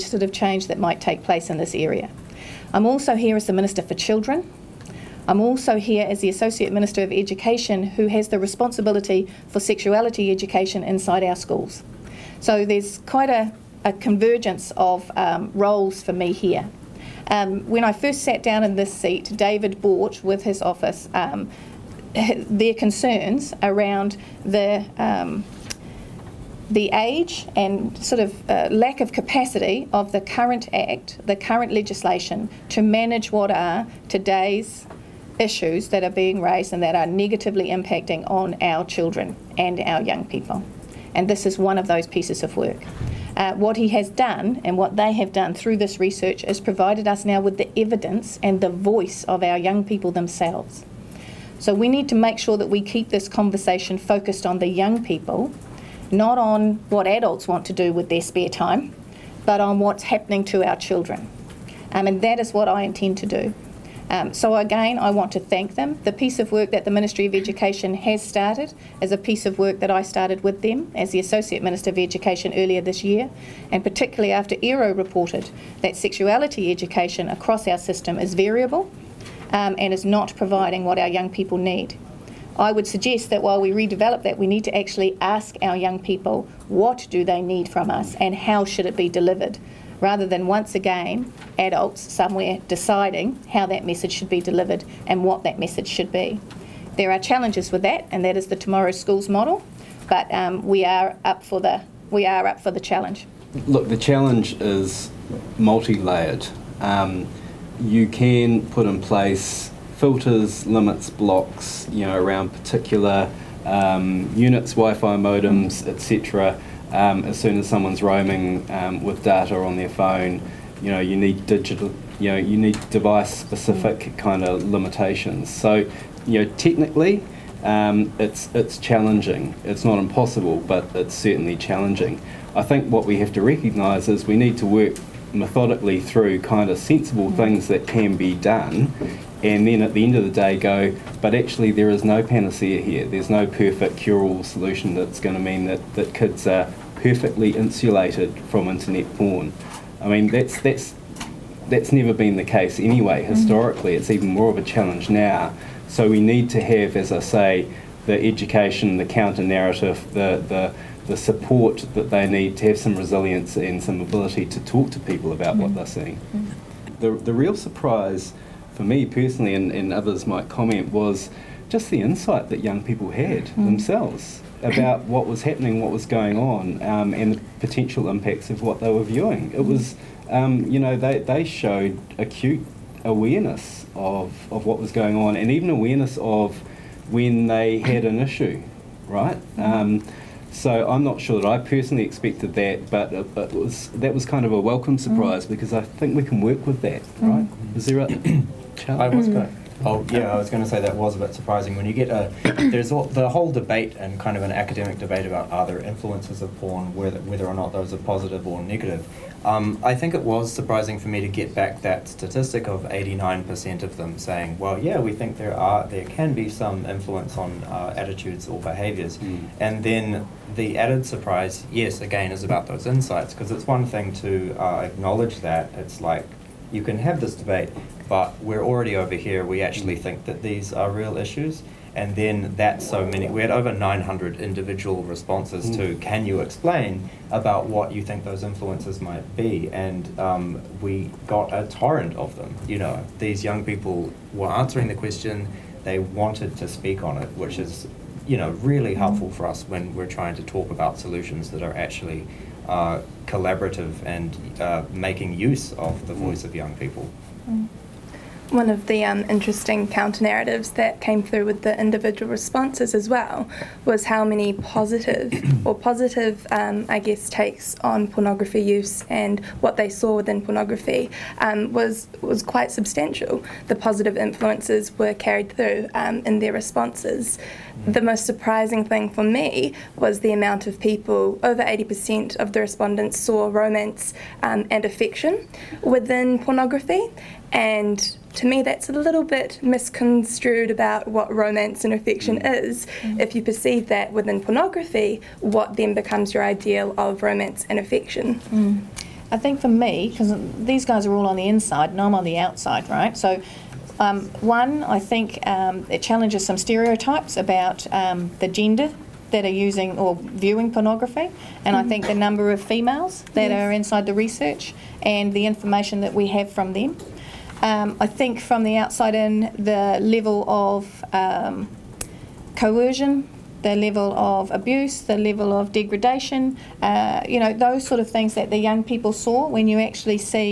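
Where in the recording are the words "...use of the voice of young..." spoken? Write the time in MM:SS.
04:15.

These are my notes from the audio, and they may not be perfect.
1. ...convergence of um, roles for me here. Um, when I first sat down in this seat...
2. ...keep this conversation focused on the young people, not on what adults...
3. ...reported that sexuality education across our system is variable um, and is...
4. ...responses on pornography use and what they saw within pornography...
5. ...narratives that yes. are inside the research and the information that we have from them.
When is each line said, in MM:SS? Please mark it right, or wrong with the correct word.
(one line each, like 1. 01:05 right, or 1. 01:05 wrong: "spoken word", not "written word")
1. 00:13 right
2. 00:52 right
3. 01:14 right
4. 04:27 wrong: "takes", not "responses"
5. 05:12 wrong: "females", not "narratives".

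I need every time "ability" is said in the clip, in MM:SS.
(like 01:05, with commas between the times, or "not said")
02:44.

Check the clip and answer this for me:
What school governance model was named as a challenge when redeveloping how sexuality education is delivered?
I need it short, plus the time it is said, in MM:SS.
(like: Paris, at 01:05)
Tomorrow Schools, at 01:38.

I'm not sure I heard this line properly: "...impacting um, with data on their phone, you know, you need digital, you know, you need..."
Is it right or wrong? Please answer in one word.
wrong.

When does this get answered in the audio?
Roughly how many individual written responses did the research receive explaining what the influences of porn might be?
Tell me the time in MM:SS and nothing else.
03:53.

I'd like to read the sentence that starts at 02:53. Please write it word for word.
themselves about what was happening, what was going on, um, and the potential impacts of what they were viewing.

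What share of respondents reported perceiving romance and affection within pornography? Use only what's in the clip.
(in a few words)
Over 80%.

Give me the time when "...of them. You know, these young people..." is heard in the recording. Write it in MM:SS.
04:02.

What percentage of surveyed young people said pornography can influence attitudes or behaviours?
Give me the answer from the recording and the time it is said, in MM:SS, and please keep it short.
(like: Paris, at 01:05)
89%, at 03:32.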